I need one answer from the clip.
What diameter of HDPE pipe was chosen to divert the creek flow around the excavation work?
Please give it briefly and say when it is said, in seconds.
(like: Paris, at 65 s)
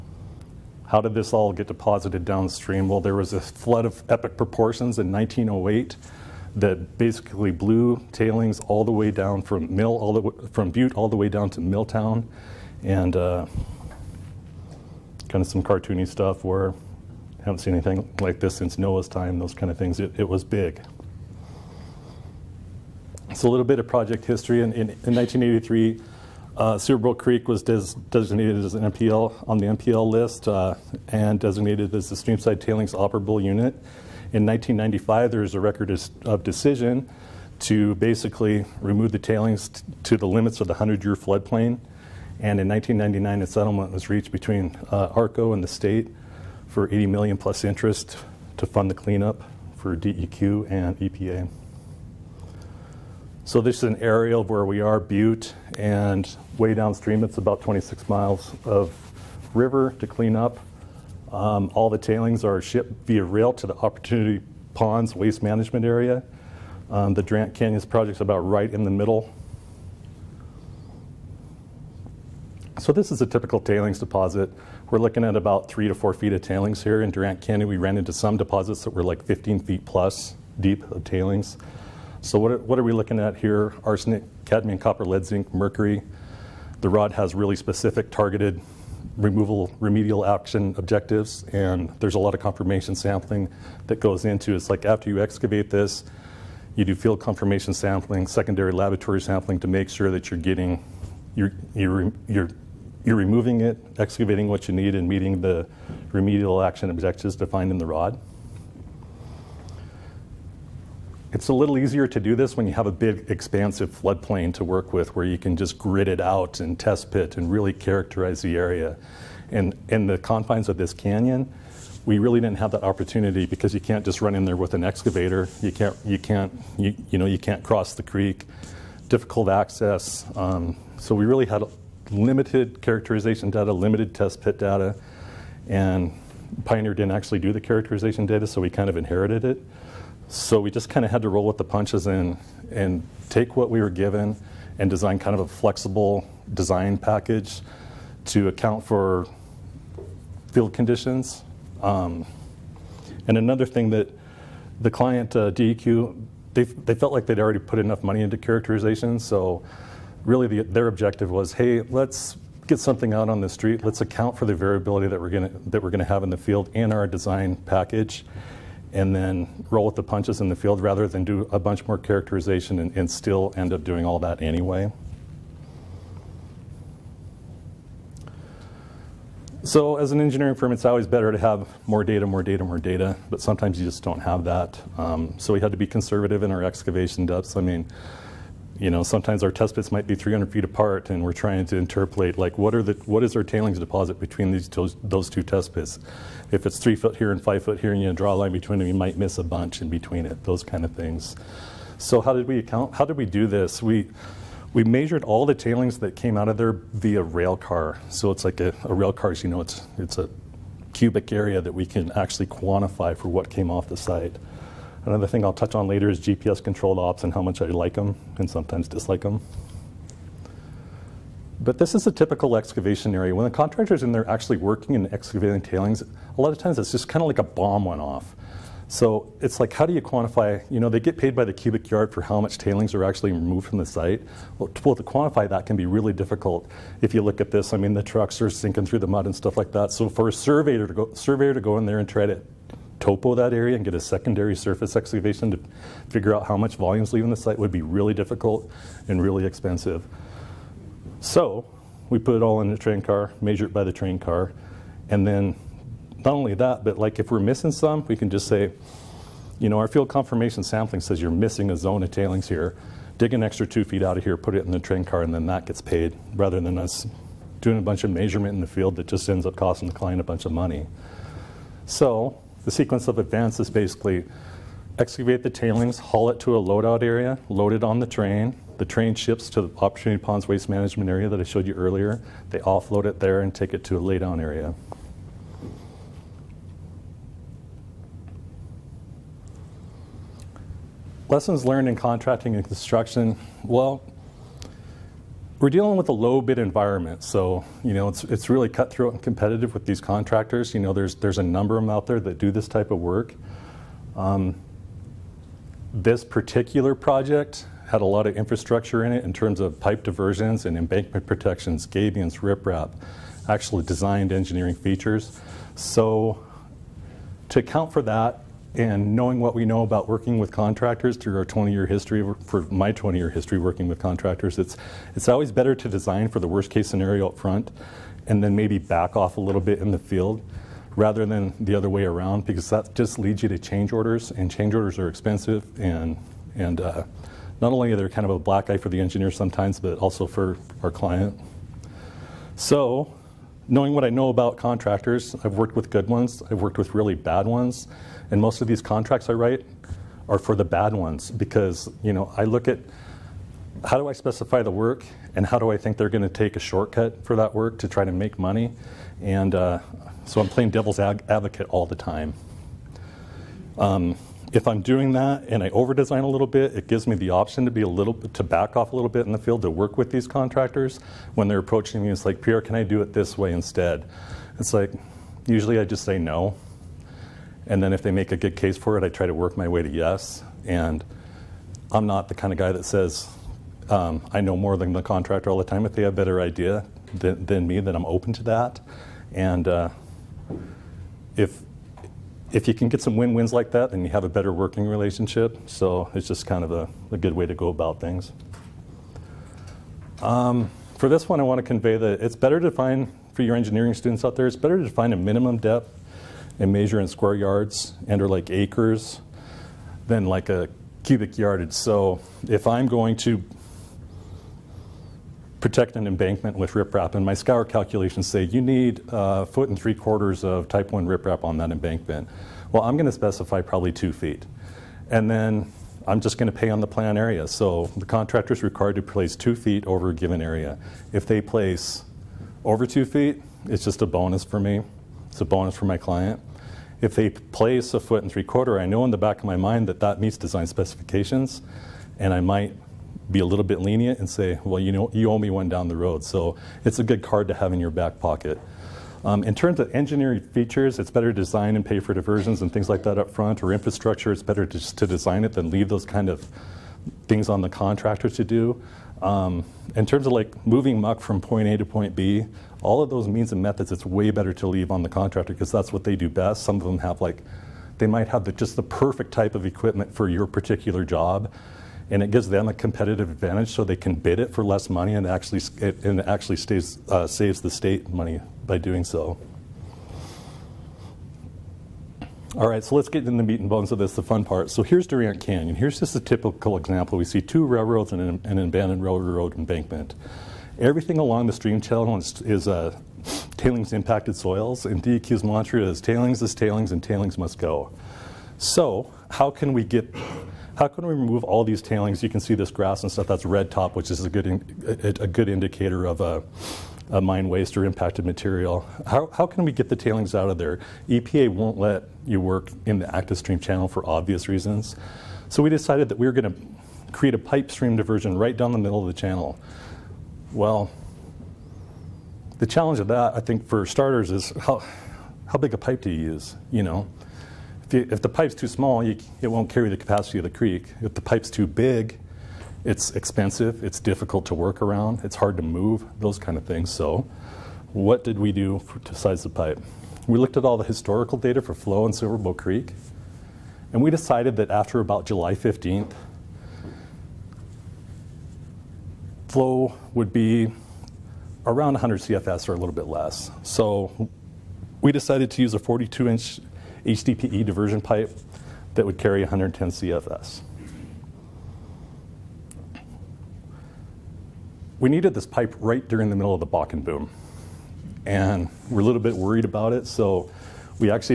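42 inches, at 555 s.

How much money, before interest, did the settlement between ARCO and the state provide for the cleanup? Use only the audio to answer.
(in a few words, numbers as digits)
$80 million.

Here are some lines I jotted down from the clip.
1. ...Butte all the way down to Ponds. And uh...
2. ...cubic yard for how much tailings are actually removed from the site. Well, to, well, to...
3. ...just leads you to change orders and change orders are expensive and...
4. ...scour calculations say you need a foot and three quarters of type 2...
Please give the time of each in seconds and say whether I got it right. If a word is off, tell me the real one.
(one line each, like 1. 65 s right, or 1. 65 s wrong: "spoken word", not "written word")
1. 10 s wrong: "Milltown", not "Ponds"
2. 231 s right
3. 332 s right
4. 417 s wrong: "1", not "2".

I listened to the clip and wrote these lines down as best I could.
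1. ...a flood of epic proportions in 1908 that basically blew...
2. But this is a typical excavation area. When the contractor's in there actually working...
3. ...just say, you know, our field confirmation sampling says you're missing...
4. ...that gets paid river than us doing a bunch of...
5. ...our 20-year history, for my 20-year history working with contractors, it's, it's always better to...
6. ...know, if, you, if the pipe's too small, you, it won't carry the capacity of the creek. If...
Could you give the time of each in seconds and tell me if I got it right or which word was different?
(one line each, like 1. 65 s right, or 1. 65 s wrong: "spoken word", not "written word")
1. 3 s right
2. 221 s right
3. 258 s right
4. 265 s wrong: "rather", not "river"
5. 321 s right
6. 526 s right.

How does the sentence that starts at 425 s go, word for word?
And then I'm just going to pay on the plan area.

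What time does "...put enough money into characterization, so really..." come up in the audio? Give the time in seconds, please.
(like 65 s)
157 s.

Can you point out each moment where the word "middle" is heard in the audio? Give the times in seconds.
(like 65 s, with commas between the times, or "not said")
68 s, 518 s, 566 s.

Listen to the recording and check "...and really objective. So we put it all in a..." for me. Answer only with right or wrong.
wrong.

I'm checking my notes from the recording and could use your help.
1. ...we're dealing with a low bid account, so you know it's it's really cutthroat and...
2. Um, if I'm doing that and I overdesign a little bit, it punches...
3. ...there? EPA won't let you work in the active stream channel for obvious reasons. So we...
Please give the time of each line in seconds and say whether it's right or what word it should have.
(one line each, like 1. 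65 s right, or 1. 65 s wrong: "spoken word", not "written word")
1. 295 s wrong: "environment", not "account"
2. 363 s wrong: "gives", not "punches"
3. 510 s right.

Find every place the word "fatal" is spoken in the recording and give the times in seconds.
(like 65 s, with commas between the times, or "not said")
not said.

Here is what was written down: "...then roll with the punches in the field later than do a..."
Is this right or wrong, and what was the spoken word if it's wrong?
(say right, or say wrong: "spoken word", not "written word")
wrong: "rather", not "later".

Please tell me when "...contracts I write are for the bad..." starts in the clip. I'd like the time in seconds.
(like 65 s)
348 s.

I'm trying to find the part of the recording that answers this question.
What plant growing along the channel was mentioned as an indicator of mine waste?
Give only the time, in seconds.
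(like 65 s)
503 s.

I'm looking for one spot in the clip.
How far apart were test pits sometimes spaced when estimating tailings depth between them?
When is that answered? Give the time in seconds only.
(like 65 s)
190 s.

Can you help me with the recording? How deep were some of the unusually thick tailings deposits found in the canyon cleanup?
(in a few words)
15 feet.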